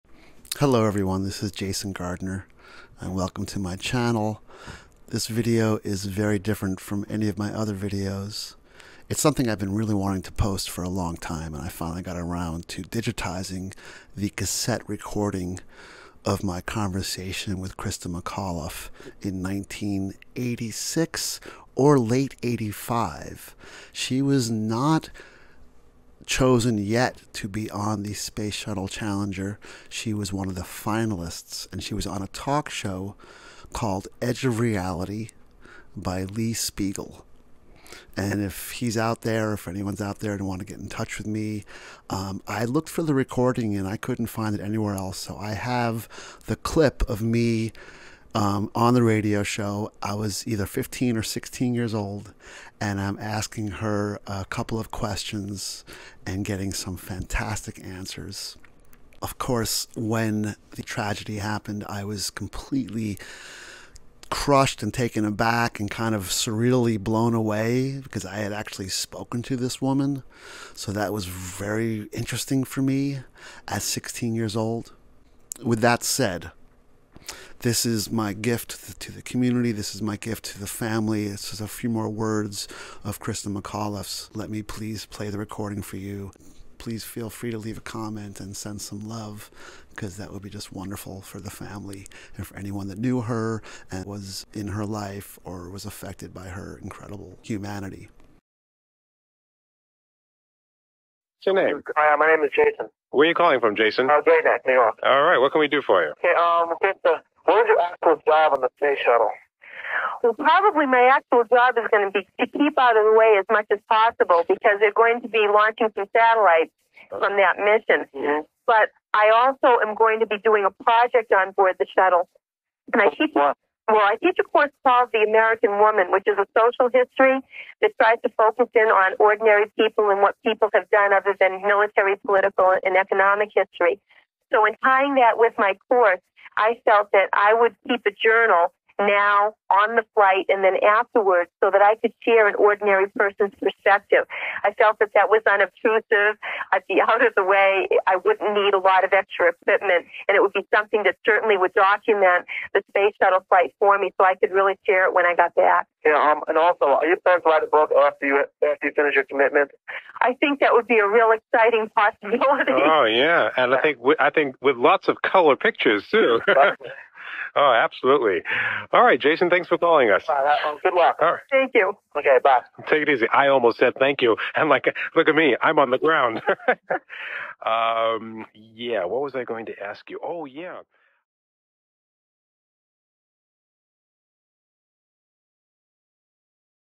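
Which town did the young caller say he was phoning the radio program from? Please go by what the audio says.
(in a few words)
Great Neck, New York.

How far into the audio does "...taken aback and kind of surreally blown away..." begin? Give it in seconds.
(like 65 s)
64 s.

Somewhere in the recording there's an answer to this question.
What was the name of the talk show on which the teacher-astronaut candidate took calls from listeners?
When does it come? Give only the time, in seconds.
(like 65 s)
34 s.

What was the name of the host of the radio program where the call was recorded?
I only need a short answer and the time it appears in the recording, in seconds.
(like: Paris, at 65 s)
Lee Speigel, at 36 s.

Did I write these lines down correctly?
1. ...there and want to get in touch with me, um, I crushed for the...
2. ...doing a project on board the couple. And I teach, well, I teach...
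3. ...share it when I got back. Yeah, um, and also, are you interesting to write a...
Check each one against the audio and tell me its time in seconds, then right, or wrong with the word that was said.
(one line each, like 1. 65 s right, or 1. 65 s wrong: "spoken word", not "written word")
1. 40 s wrong: "looked", not "crushed"
2. 120 s wrong: "shuttle", not "couple"
3. 154 s wrong: "planning", not "interesting".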